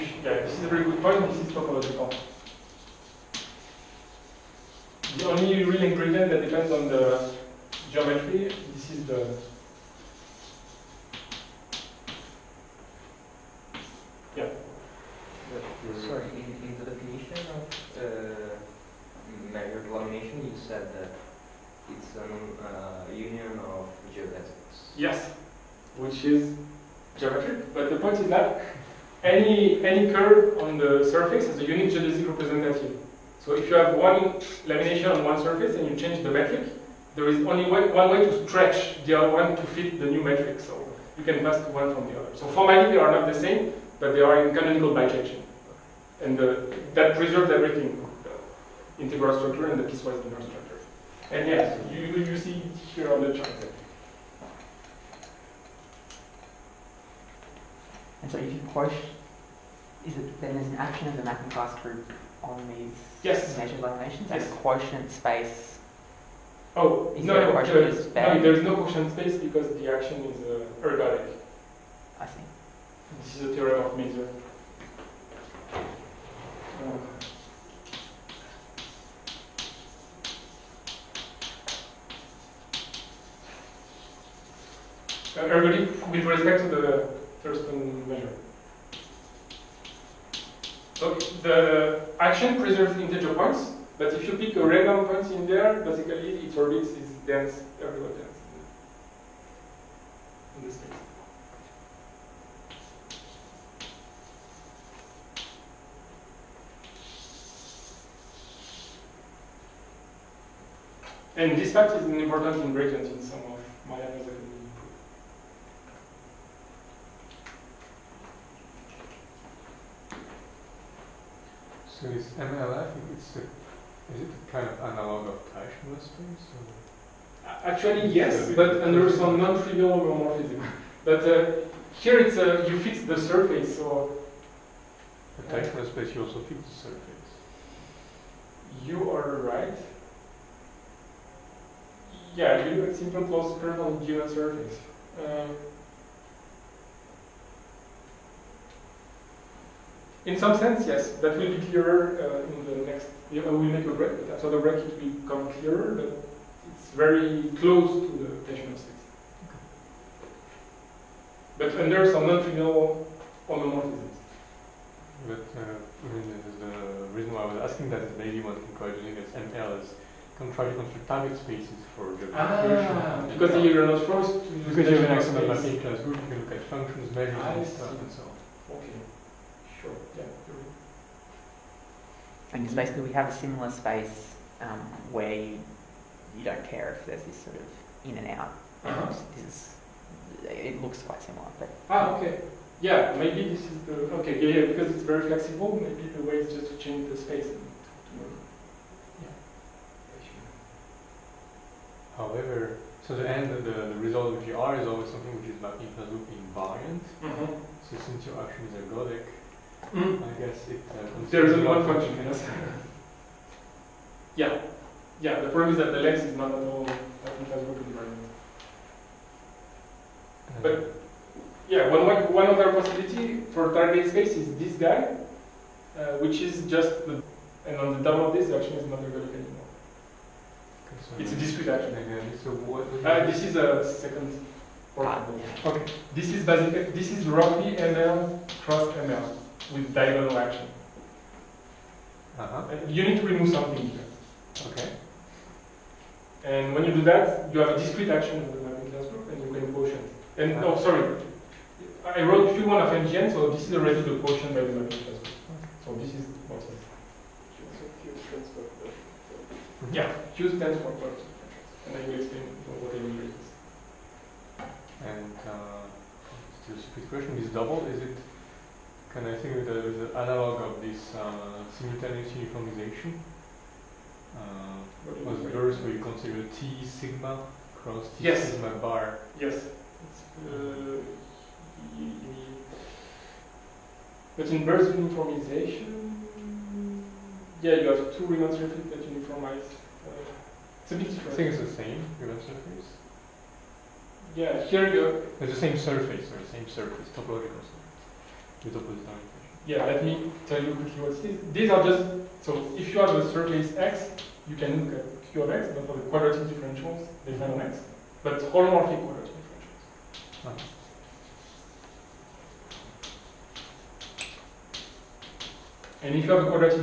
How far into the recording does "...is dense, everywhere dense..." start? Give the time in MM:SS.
01:36.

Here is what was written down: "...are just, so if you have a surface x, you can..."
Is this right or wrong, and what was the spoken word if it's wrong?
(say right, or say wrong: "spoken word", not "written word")
right.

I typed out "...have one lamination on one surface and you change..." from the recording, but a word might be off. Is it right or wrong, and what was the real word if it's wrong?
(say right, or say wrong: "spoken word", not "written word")
right.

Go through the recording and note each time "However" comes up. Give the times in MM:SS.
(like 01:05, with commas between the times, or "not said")
03:22.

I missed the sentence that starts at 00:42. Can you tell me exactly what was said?
So formally they are not the same, but they are in canonical bijection.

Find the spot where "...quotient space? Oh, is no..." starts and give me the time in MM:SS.
01:04.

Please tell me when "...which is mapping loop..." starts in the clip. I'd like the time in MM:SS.
03:25.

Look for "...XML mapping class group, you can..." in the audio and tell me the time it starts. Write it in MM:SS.
02:55.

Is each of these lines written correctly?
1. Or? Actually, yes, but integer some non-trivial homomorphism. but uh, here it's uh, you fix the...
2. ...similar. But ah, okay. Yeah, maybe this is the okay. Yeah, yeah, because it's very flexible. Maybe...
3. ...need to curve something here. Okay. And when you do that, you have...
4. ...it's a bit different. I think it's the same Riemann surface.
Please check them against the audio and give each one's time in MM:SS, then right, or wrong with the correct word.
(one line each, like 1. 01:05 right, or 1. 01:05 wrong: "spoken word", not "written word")
1. 02:06 wrong: "under", not "integer"
2. 03:11 right
3. 04:03 wrong: "remove", not "curve"
4. 04:50 right.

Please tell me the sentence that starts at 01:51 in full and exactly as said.
And this fact is important in Bracant in some of my analysis.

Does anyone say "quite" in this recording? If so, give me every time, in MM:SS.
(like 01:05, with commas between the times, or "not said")
02:48, 03:11.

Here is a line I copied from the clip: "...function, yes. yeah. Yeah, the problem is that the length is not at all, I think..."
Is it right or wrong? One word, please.
right.